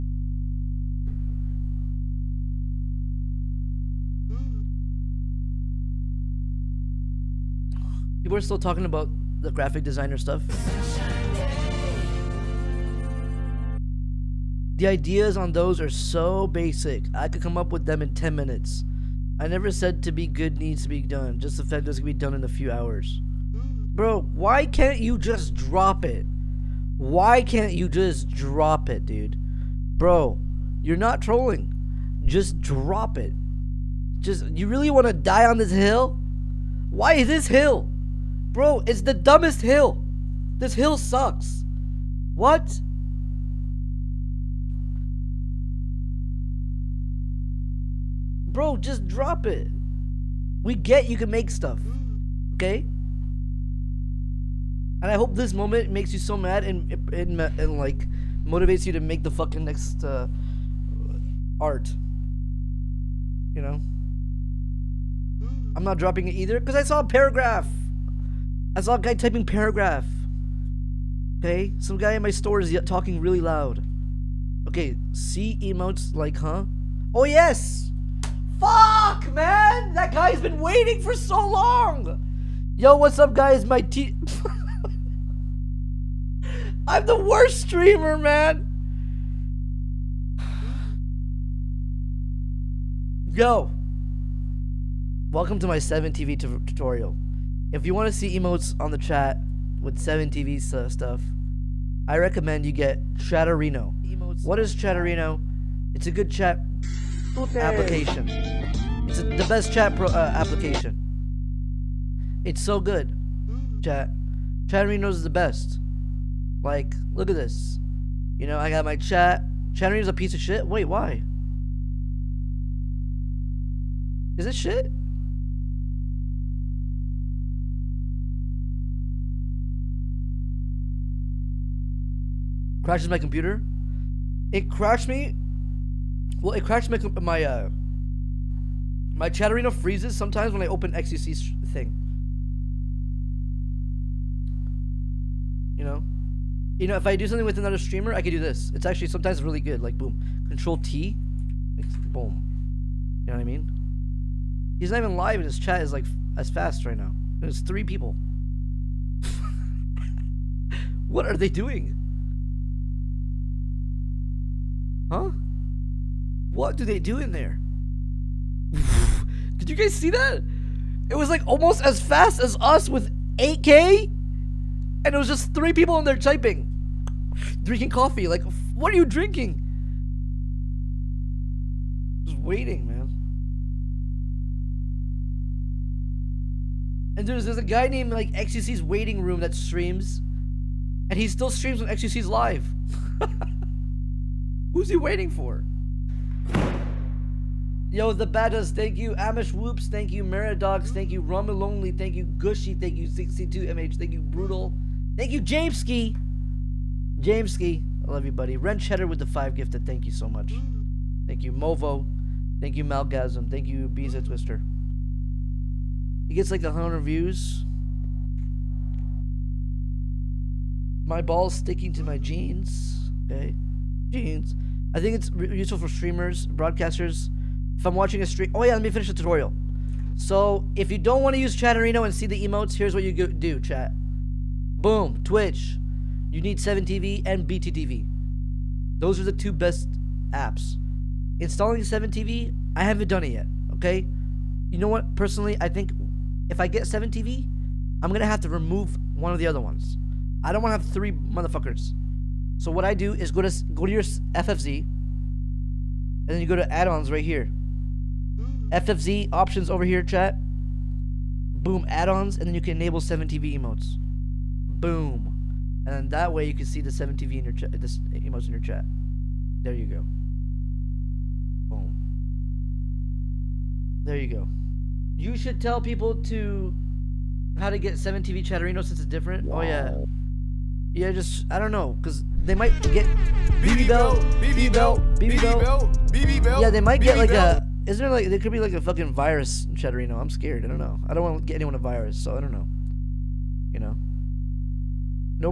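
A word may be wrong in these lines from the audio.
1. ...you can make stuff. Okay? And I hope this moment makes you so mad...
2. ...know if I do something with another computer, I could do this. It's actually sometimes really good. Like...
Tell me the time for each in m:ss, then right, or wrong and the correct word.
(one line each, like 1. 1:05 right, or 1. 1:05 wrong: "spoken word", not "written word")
1. 0:51 right
2. 2:26 wrong: "streamer", not "computer".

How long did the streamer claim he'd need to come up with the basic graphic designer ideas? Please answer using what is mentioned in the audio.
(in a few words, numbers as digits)
10 minutes.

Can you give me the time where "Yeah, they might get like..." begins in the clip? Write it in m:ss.
4:46.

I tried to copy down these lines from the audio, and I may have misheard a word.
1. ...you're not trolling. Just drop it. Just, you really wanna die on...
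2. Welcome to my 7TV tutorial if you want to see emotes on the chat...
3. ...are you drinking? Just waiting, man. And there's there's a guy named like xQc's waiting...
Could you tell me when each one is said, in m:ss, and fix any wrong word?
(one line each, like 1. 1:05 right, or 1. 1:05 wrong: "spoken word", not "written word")
1. 0:30 right
2. 1:35 right
3. 2:58 right.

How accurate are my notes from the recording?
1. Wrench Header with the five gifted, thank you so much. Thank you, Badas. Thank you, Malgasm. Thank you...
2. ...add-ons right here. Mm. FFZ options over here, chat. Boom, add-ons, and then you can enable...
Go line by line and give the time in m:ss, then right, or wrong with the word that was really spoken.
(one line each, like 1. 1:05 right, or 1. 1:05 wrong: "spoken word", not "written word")
1. 3:28 wrong: "Movo", not "Badas"
2. 4:16 right.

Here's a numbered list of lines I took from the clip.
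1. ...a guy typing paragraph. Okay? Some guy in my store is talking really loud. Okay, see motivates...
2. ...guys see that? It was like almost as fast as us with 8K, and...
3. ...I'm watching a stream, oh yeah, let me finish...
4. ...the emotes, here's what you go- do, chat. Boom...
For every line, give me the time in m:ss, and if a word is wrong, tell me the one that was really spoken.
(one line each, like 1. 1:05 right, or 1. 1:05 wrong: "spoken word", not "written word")
1. 1:08 wrong: "emotes", not "motivates"
2. 2:49 right
3. 3:47 right
4. 3:52 right.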